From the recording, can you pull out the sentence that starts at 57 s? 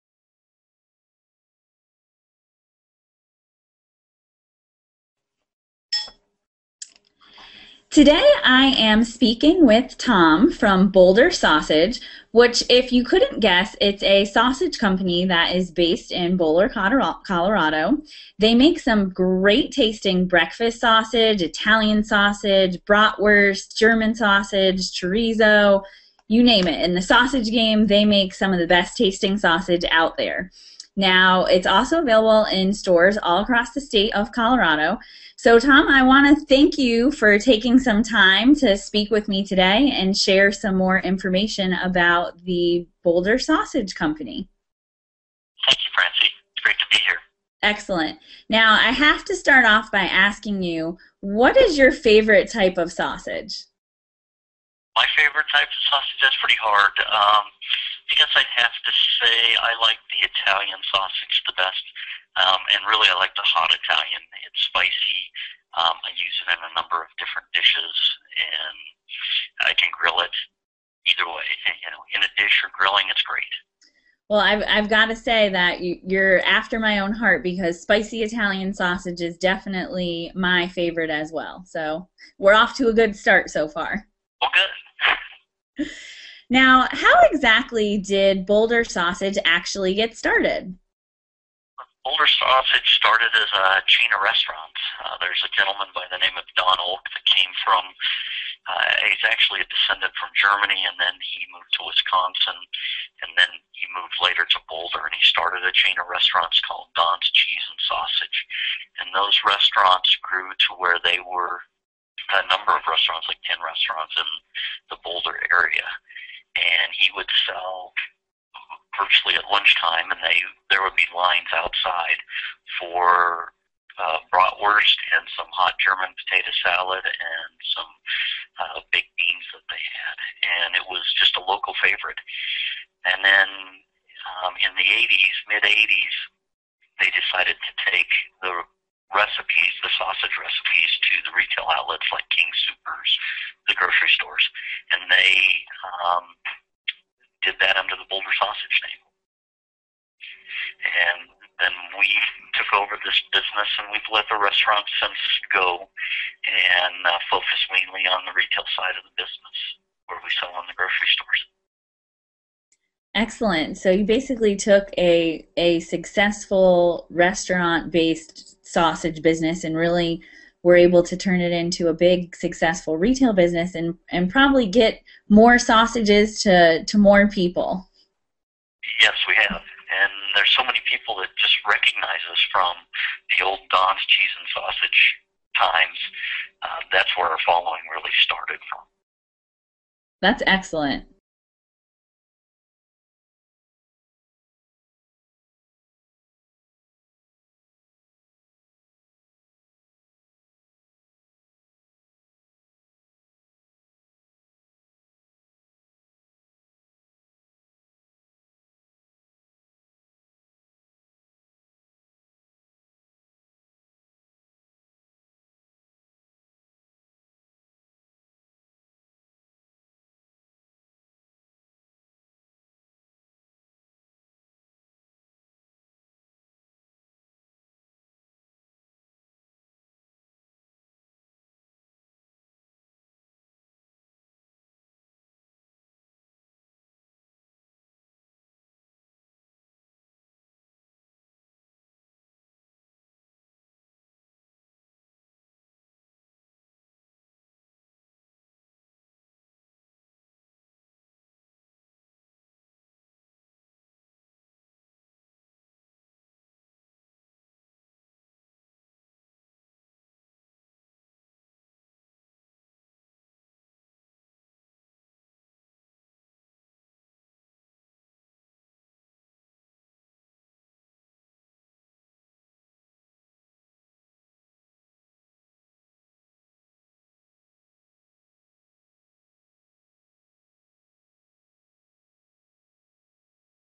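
Um, I guess I'd have to say I like the Italian sausage the best, um, and really I like the hot Italian.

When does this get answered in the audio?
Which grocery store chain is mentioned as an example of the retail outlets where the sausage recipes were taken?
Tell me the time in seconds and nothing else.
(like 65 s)
142 s.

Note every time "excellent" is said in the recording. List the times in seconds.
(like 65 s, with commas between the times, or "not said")
47 s, 163 s, 190 s.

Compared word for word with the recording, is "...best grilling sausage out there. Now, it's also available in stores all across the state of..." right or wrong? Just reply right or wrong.
wrong.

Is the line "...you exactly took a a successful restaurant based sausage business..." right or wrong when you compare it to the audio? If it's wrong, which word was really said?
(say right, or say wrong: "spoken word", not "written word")
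wrong: "basically", not "exactly".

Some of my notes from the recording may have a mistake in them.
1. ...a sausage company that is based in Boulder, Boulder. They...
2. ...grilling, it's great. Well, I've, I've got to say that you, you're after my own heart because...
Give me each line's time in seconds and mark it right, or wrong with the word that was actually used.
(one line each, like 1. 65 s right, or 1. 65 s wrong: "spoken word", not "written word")
1. 14 s wrong: "Colorado", not "Boulder"
2. 72 s right.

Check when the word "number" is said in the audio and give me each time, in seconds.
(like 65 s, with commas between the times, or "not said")
66 s, 112 s.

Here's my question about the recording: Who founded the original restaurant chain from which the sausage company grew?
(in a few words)
Don Oak.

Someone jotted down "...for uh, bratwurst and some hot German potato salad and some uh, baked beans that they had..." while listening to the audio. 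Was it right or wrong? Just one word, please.
right.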